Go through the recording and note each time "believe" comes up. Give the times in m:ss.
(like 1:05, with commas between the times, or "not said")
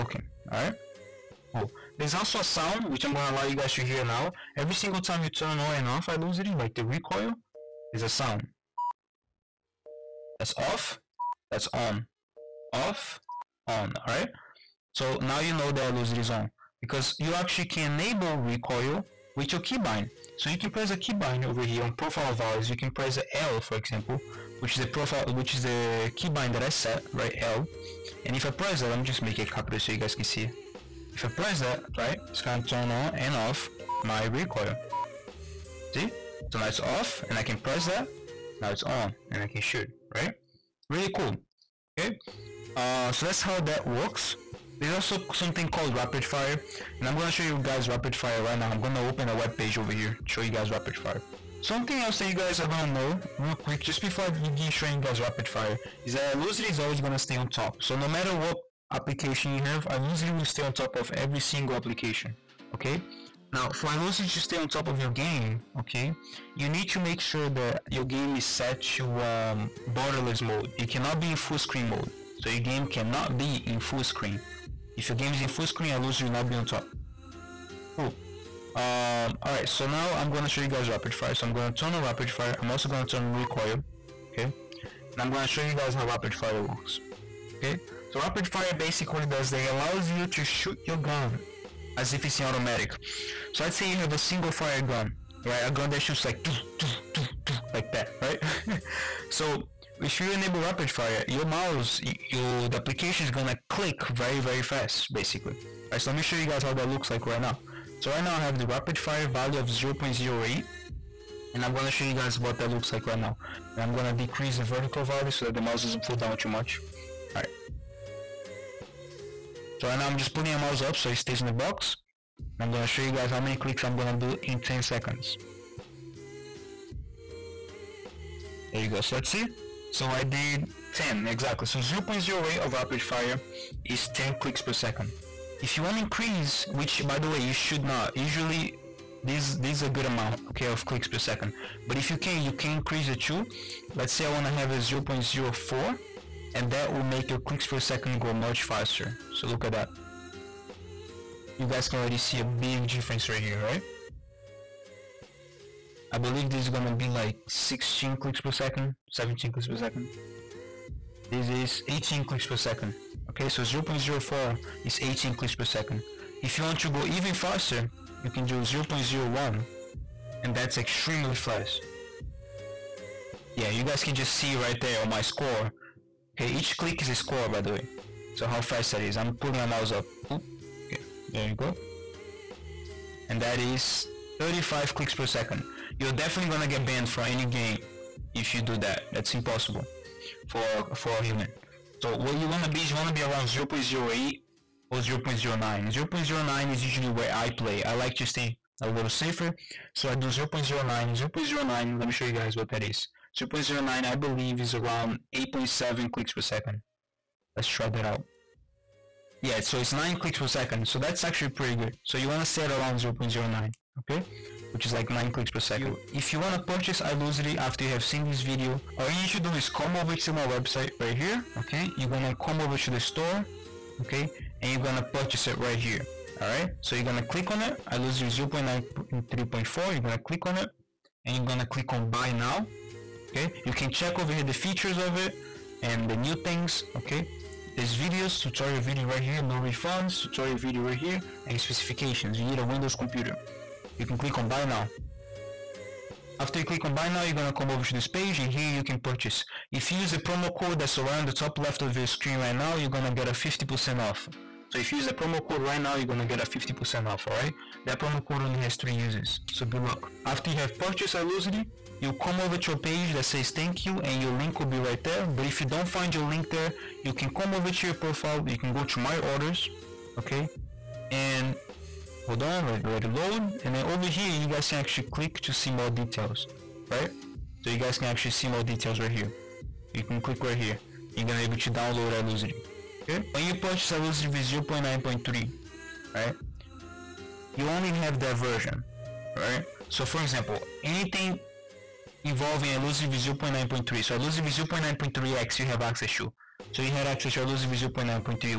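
2:36, 3:24.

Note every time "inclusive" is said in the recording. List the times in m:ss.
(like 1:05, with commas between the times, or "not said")
not said.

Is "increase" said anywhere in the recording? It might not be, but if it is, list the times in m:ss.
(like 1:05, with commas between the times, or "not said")
2:16, 2:22.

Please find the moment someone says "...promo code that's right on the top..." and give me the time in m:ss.
4:10.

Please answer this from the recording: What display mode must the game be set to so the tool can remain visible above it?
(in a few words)
borderless mode.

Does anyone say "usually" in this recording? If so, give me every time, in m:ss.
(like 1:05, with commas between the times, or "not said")
2:18, 3:16.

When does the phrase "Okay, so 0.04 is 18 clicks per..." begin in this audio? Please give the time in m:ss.
2:43.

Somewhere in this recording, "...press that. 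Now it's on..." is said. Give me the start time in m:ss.
0:37.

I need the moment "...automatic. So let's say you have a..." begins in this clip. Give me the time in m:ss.
1:32.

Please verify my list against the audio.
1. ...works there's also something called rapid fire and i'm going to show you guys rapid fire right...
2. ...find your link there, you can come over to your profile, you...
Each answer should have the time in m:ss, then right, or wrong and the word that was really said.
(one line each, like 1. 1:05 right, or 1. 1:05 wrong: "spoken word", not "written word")
1. 0:43 right
2. 4:25 right.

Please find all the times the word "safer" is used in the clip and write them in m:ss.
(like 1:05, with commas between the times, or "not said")
3:19.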